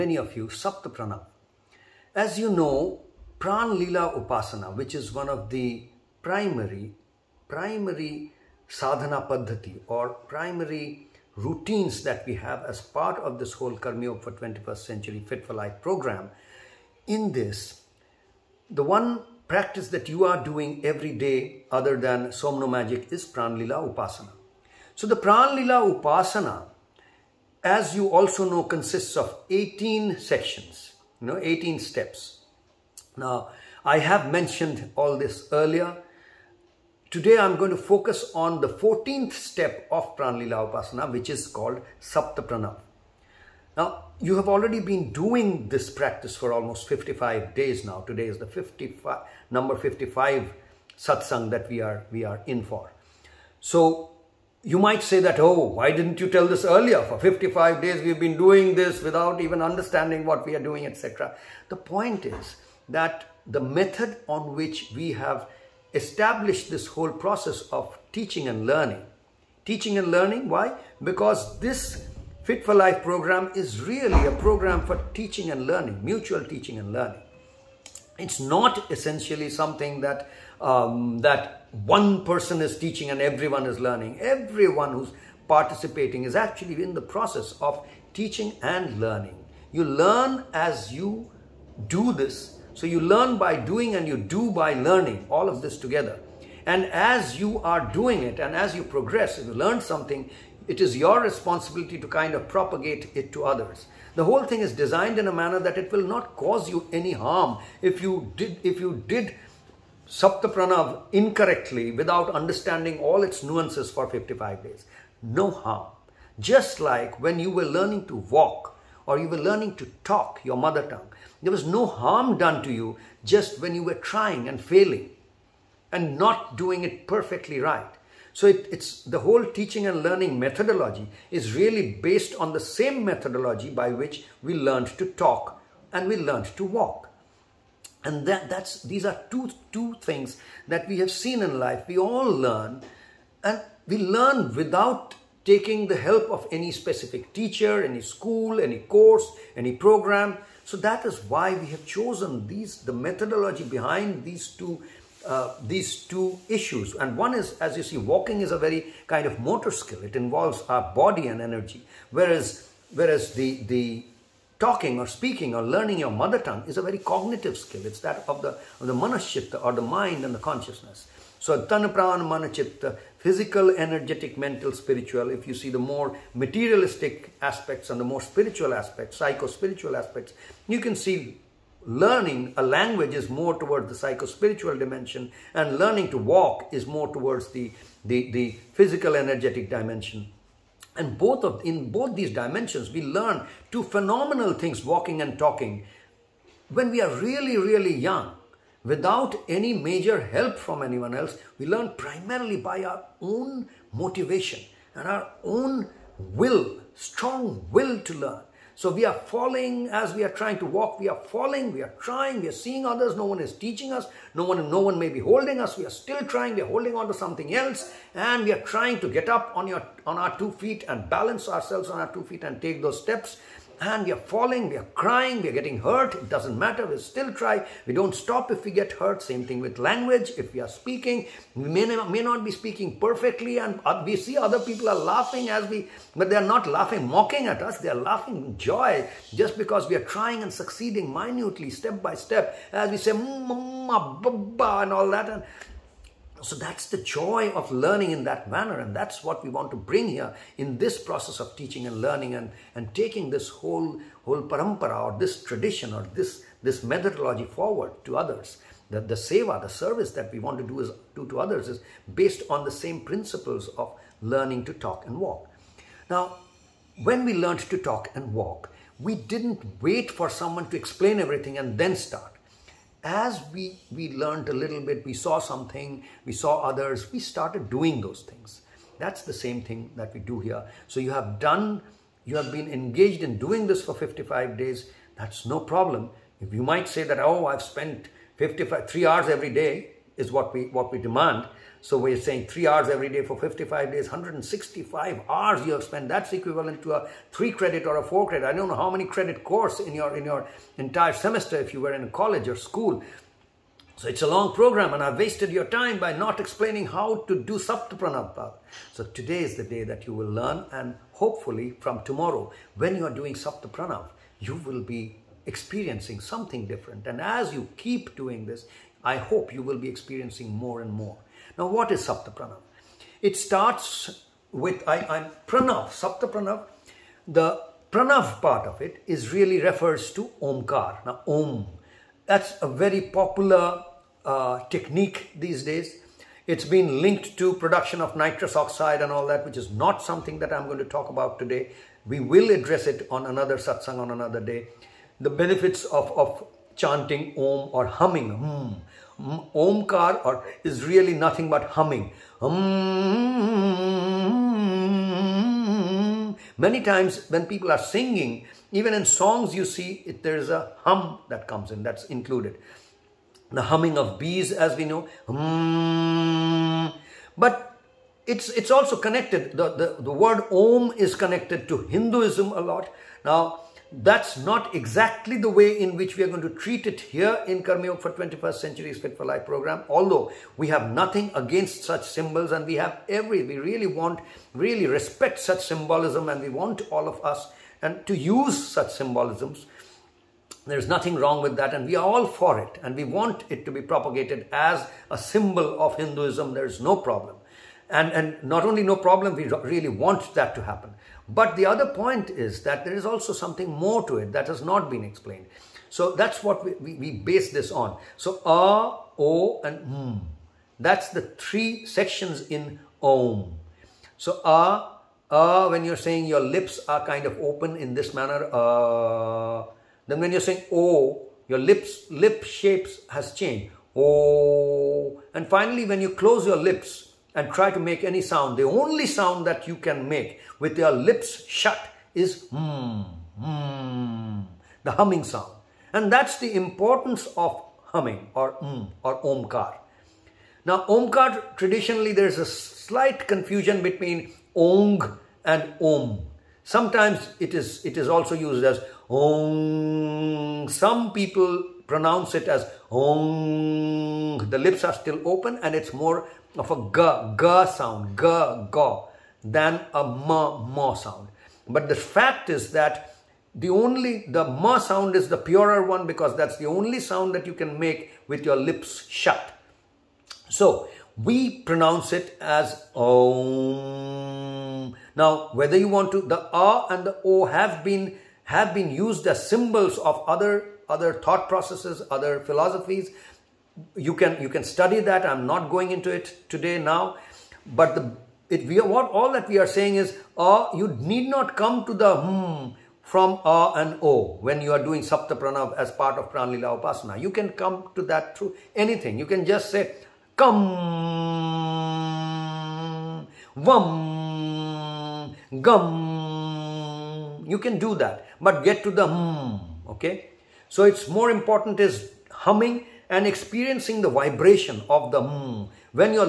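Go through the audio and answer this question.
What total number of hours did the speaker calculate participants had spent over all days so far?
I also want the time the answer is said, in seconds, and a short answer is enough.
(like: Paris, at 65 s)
165, at 294 s.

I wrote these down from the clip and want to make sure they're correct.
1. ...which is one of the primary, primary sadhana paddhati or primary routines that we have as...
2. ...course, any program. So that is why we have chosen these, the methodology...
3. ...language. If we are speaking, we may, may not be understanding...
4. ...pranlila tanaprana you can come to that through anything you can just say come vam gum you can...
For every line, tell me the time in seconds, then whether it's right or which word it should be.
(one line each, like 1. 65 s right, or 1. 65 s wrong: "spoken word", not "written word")
1. 4 s right
2. 148 s right
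3. 229 s wrong: "speaking", not "understanding"
4. 496 s wrong: "upasana", not "tanaprana".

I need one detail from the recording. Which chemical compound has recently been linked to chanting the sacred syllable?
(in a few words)
nitrous oxide.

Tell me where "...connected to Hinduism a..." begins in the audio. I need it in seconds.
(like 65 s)
371 s.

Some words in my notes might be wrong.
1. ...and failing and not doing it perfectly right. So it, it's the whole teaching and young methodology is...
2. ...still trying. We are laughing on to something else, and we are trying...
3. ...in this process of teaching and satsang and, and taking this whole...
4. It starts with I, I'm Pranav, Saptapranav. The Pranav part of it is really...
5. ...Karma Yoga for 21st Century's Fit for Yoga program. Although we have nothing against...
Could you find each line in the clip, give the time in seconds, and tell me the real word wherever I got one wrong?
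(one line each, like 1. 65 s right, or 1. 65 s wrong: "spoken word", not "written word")
1. 124 s wrong: "learning", not "young"
2. 216 s wrong: "holding", not "laughing"
3. 250 s wrong: "learning", not "satsang"
4. 323 s right
5. 377 s wrong: "Life", not "Yoga".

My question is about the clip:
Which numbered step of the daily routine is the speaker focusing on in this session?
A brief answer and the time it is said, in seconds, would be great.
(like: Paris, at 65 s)
14th, at 38 s.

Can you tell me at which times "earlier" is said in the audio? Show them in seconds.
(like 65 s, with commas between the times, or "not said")
35 s, 56 s.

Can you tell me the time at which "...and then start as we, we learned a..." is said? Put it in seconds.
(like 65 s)
271 s.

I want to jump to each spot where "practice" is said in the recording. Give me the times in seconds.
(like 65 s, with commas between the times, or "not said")
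19 s, 45 s.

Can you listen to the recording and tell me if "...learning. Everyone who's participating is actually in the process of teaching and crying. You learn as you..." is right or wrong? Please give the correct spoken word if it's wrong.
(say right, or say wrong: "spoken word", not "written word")
wrong: "learning", not "crying".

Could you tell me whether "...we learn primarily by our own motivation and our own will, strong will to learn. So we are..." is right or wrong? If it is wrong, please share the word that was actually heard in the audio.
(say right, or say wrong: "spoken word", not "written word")
right.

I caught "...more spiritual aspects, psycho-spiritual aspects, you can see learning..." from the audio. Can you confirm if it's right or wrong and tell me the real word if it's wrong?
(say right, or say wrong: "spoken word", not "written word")
right.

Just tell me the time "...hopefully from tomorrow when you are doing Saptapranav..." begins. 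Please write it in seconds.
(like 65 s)
311 s.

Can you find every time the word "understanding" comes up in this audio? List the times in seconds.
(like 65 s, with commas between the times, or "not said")
59 s, 112 s.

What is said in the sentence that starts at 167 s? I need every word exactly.
It's that of the, of the manaschitta or the mind and the consciousness.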